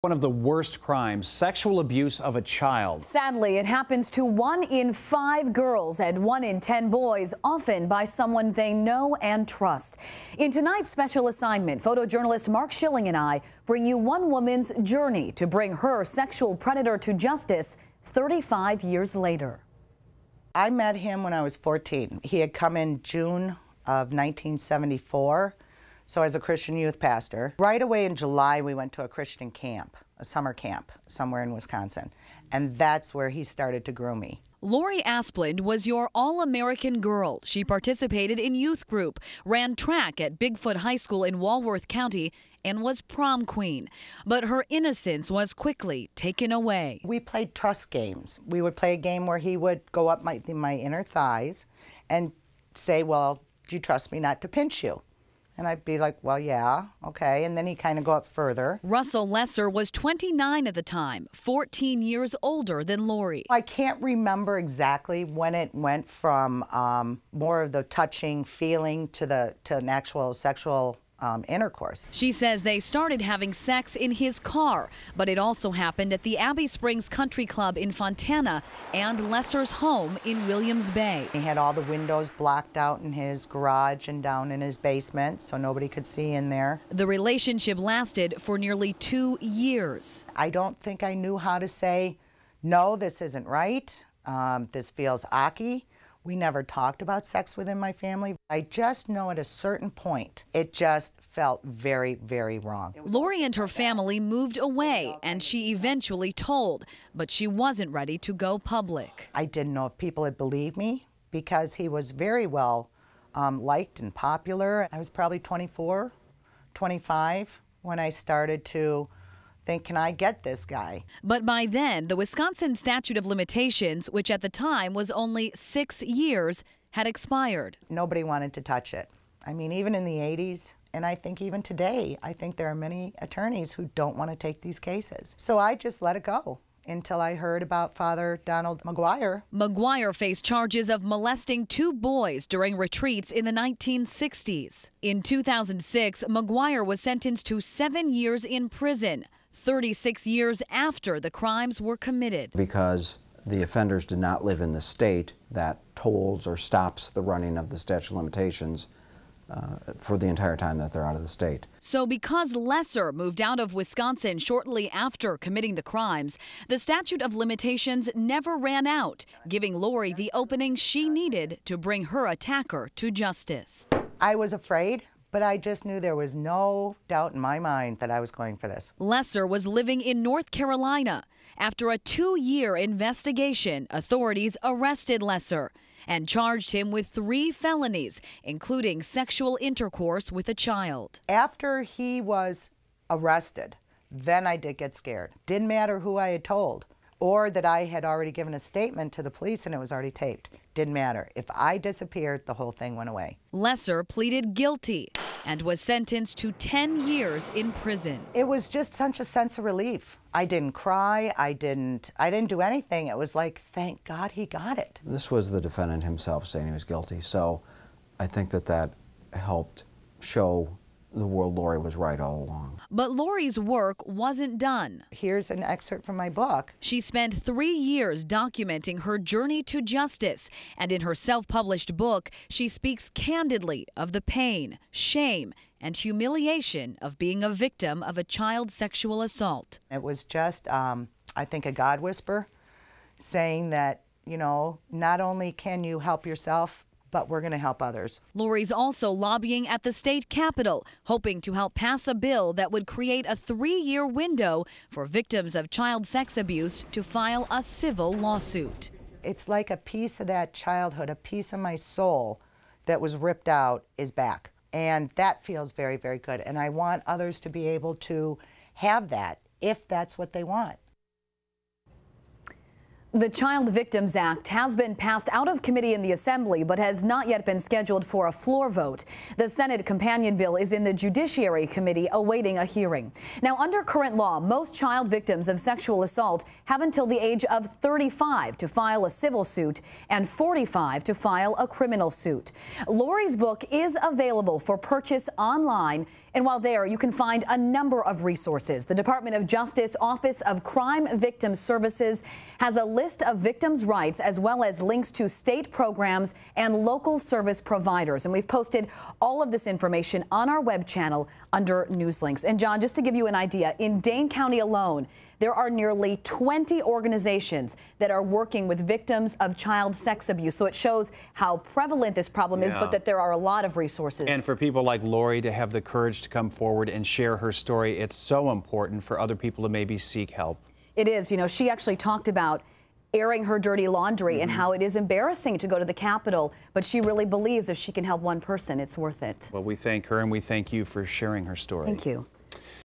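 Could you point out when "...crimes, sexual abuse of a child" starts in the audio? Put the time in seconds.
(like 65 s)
0 s.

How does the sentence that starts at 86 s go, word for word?
The relationship lasted for nearly two years.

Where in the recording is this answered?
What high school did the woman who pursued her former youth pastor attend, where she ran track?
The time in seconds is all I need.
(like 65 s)
40 s.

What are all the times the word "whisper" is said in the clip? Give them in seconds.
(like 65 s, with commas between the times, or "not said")
241 s.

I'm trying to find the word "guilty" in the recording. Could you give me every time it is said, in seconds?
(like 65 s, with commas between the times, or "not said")
204 s, 216 s.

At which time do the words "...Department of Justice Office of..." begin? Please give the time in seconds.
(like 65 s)
298 s.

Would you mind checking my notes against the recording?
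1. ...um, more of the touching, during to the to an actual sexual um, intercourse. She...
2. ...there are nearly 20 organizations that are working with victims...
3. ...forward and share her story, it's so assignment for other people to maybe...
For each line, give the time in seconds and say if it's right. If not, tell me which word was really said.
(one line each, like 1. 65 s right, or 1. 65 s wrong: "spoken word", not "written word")
1. 66 s wrong: "feeling", not "during"
2. 315 s right
3. 326 s wrong: "important", not "assignment".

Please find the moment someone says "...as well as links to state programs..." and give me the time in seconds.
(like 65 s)
304 s.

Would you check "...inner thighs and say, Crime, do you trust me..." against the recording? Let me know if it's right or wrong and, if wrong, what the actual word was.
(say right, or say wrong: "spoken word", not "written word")
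wrong: "Well", not "Crime".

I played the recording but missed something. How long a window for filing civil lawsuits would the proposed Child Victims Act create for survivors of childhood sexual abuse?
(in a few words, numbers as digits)
3 years.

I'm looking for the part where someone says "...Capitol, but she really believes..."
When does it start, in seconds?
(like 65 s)
336 s.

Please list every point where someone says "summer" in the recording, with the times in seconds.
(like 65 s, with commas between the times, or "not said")
30 s.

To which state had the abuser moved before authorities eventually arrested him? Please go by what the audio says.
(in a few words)
North Carolina.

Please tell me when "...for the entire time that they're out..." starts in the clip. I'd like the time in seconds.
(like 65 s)
159 s.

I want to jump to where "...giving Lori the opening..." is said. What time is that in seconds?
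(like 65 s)
169 s.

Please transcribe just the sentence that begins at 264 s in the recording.
And that feels very, very good.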